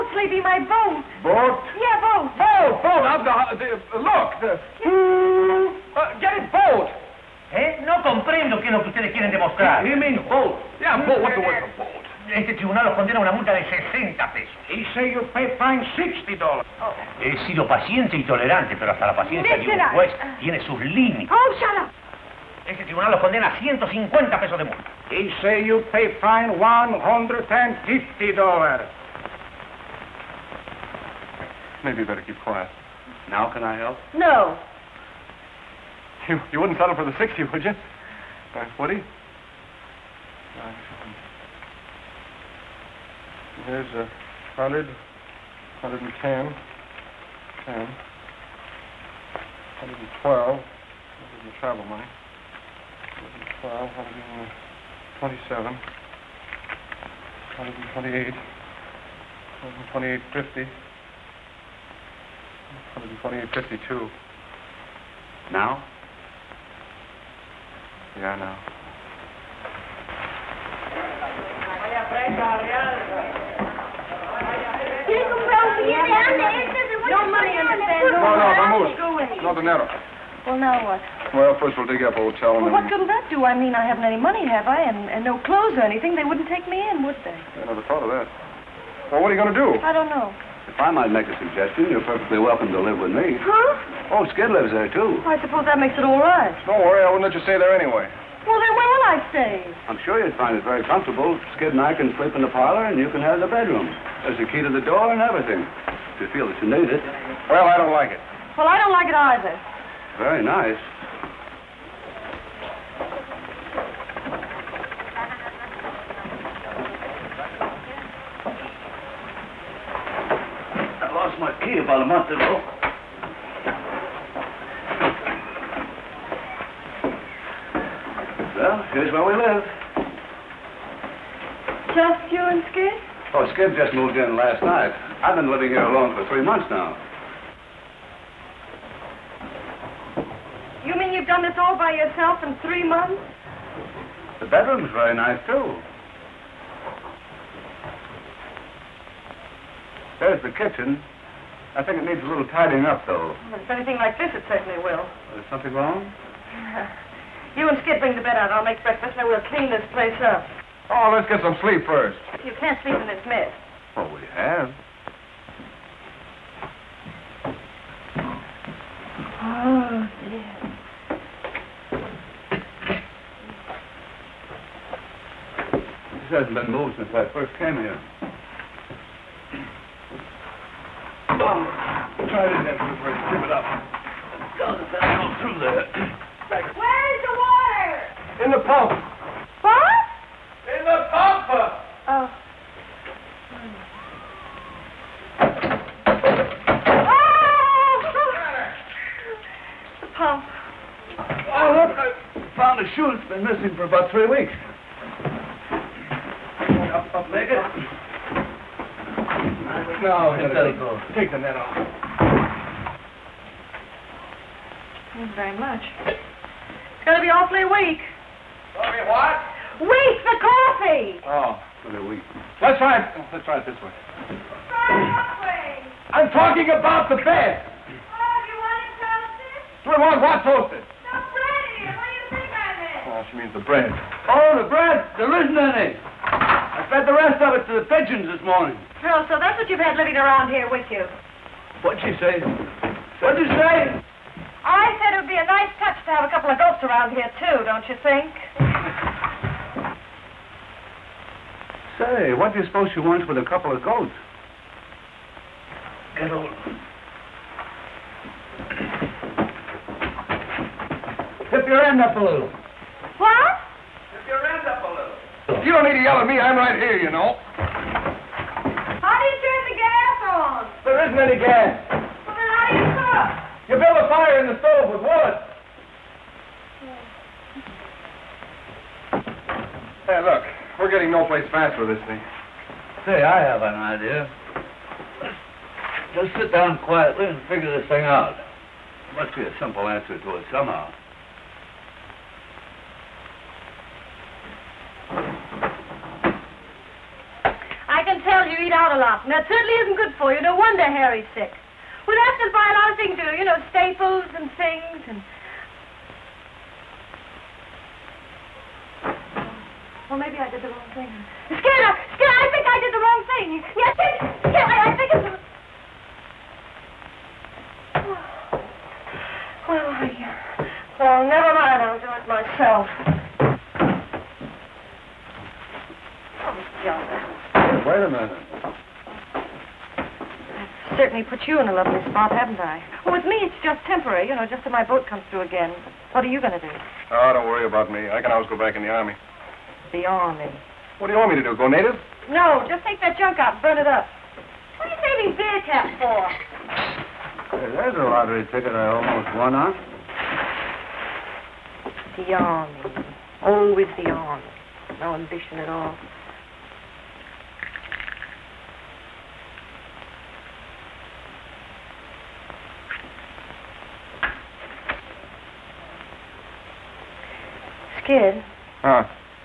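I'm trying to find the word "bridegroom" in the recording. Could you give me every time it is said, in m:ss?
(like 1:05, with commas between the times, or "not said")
not said.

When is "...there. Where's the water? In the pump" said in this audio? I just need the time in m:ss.
3:05.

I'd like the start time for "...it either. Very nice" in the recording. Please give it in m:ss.
1:49.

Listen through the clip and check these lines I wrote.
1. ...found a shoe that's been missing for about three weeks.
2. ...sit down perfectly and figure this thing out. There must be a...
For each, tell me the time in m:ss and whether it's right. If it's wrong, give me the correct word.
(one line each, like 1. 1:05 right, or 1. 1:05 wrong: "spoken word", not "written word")
1. 3:22 right
2. 4:46 wrong: "quietly", not "perfectly".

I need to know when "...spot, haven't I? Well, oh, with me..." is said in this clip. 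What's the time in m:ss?
5:32.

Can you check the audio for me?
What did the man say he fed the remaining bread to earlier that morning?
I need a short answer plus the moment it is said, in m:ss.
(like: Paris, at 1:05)
the pigeons, at 3:57.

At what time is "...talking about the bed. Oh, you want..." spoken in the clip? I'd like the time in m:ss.
3:46.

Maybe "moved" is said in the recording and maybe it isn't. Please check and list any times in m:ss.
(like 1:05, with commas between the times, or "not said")
2:13, 2:56.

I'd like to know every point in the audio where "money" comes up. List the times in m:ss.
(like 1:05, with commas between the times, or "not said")
0:51, 1:17, 1:24.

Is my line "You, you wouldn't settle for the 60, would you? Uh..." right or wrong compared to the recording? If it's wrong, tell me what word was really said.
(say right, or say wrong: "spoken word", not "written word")
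right.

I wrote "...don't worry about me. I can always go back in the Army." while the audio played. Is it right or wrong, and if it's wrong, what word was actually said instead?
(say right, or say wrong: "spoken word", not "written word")
right.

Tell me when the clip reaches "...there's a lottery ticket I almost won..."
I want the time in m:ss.
5:47.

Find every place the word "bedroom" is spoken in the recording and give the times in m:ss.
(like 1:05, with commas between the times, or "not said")
1:43, 2:24.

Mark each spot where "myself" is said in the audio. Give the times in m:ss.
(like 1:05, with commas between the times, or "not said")
5:22.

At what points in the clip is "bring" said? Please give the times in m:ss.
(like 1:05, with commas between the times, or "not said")
2:38.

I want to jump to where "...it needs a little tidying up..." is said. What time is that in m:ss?
2:32.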